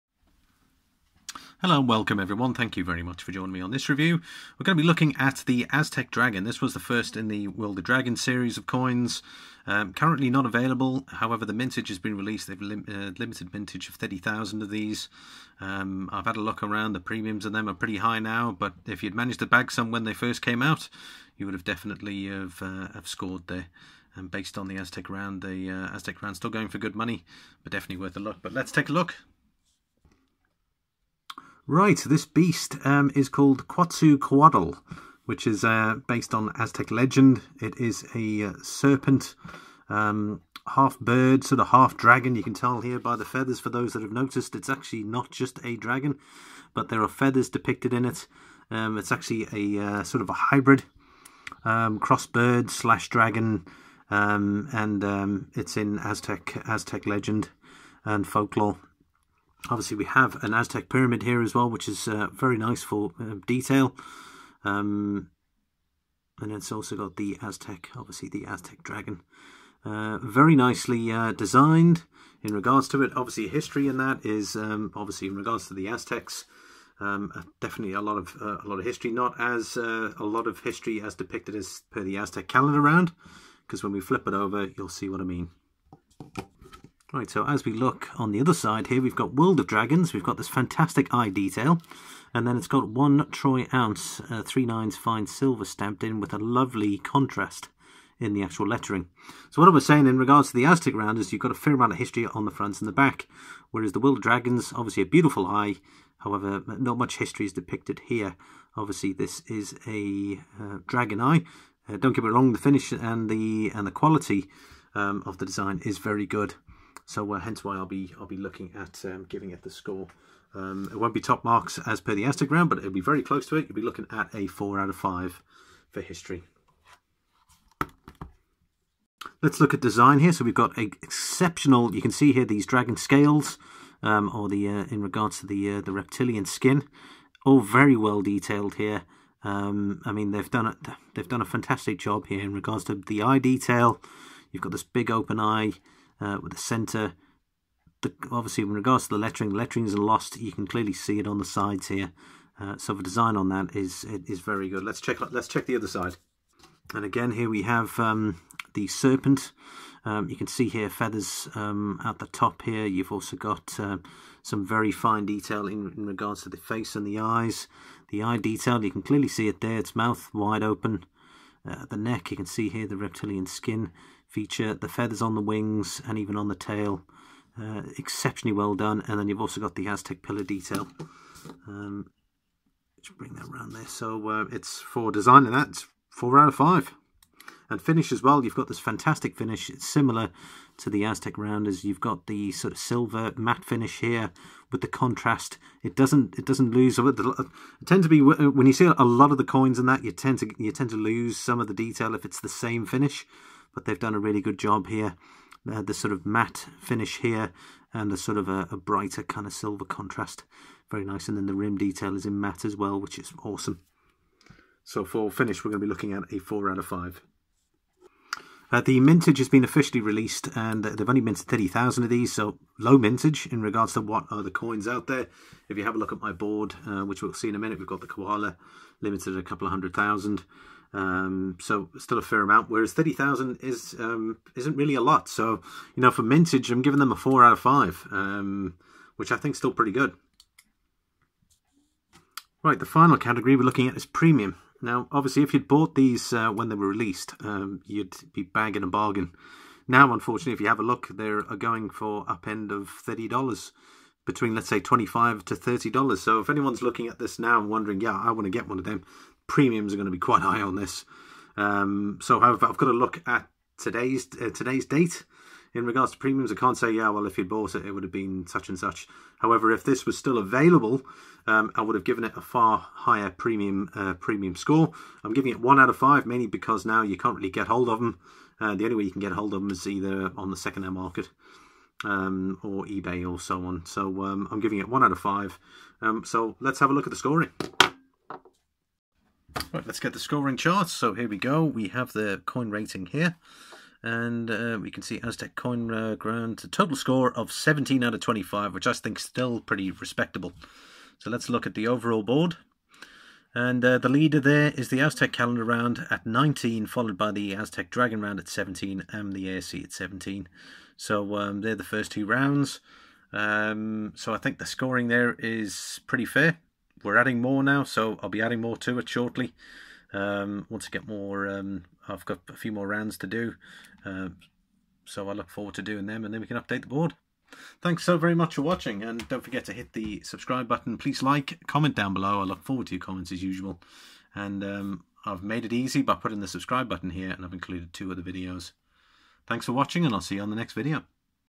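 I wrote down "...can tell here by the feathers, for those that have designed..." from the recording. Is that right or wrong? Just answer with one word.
wrong.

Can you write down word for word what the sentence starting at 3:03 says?
So uh, it's for designing that, it's four out of five.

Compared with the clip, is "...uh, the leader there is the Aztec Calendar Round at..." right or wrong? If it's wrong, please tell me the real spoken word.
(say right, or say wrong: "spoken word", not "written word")
right.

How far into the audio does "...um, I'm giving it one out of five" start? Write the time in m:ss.
4:44.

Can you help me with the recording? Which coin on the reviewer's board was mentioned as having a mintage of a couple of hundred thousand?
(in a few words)
Koala.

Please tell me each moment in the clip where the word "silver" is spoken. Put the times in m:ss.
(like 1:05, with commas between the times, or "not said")
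1:35, 3:12, 3:29.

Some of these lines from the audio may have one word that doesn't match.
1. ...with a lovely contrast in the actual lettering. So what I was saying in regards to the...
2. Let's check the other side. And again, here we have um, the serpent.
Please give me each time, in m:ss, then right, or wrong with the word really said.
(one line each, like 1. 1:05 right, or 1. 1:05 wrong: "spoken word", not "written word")
1. 1:36 right
2. 2:35 right.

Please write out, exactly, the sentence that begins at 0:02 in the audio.
Thank you very much for joining me on this review.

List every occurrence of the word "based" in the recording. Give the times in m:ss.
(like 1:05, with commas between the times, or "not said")
0:24, 0:36.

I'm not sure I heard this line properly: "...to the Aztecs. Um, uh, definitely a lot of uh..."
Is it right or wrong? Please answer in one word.
right.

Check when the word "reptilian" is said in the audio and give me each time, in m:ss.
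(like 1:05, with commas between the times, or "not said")
2:15, 2:52.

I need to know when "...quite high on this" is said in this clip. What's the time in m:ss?
4:20.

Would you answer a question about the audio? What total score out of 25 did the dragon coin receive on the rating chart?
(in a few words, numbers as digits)
17.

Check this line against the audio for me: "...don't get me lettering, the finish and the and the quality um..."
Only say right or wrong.
wrong.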